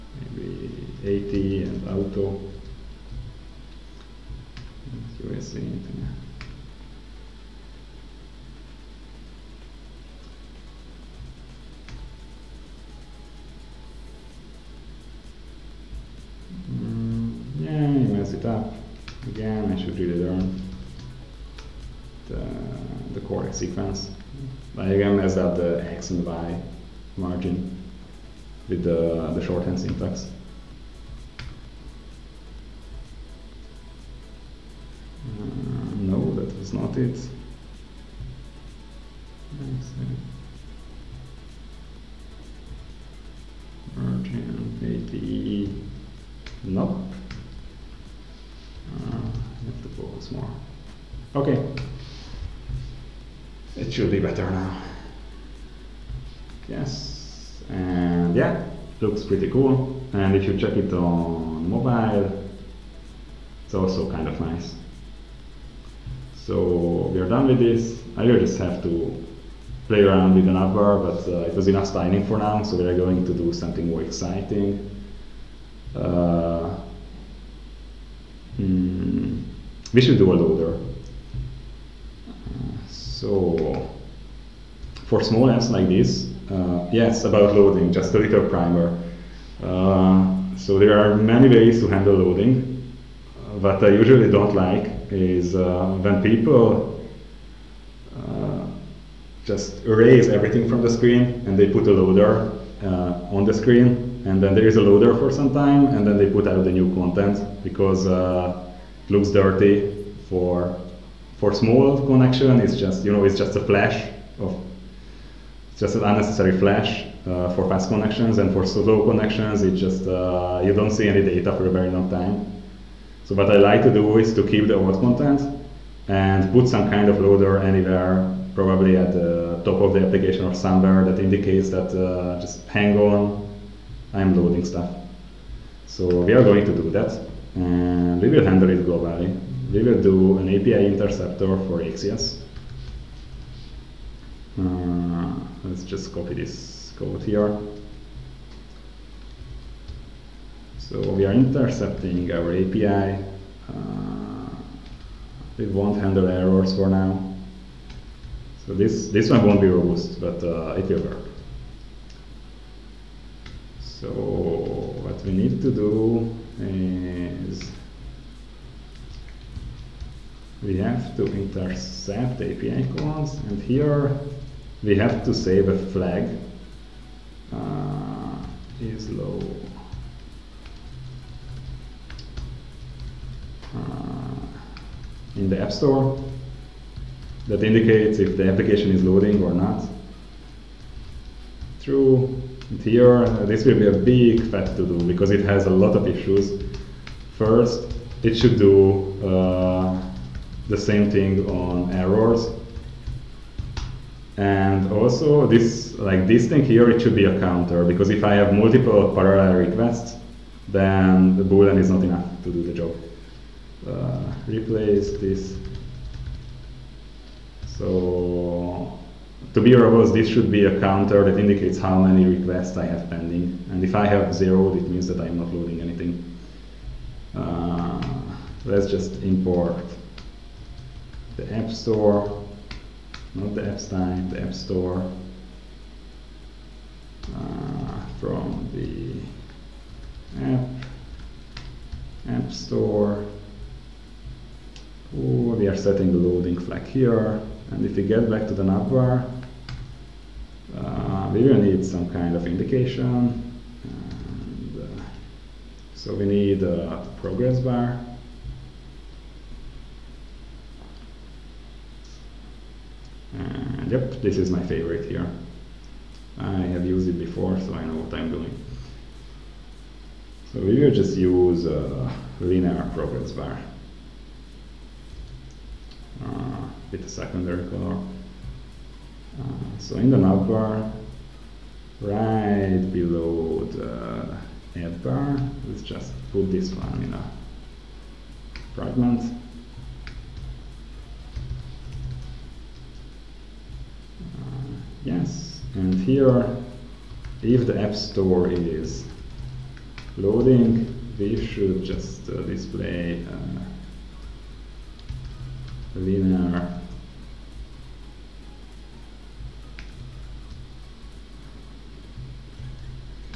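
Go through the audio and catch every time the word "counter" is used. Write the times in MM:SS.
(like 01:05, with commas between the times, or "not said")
03:27, 03:40.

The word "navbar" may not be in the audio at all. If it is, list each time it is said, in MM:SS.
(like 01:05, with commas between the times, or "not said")
04:08, 04:40.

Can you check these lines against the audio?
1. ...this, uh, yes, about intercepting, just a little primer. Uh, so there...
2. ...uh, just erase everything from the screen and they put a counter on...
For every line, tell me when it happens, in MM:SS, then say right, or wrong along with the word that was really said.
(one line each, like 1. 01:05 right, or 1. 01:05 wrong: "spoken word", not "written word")
1. 01:25 wrong: "loading", not "intercepting"
2. 01:38 wrong: "loader", not "counter".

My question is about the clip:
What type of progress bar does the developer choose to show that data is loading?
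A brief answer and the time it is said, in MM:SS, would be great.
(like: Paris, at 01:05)
linear progress bar, at 04:32.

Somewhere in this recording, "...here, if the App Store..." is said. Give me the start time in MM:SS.
04:55.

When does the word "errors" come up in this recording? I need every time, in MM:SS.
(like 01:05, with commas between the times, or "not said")
02:36, 03:21.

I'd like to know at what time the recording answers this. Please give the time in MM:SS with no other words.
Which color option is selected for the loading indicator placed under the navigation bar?
04:37.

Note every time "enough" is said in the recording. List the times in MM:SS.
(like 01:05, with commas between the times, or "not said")
01:11, 03:32.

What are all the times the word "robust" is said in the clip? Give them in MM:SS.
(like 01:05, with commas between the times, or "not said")
02:39, 03:39.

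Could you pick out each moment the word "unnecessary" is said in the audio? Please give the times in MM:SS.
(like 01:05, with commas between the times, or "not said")
01:56.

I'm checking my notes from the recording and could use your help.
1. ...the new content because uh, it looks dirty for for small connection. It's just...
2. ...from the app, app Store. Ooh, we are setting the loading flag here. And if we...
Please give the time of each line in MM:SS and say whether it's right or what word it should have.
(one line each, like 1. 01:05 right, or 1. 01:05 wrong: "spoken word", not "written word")
1. 01:46 right
2. 03:58 right.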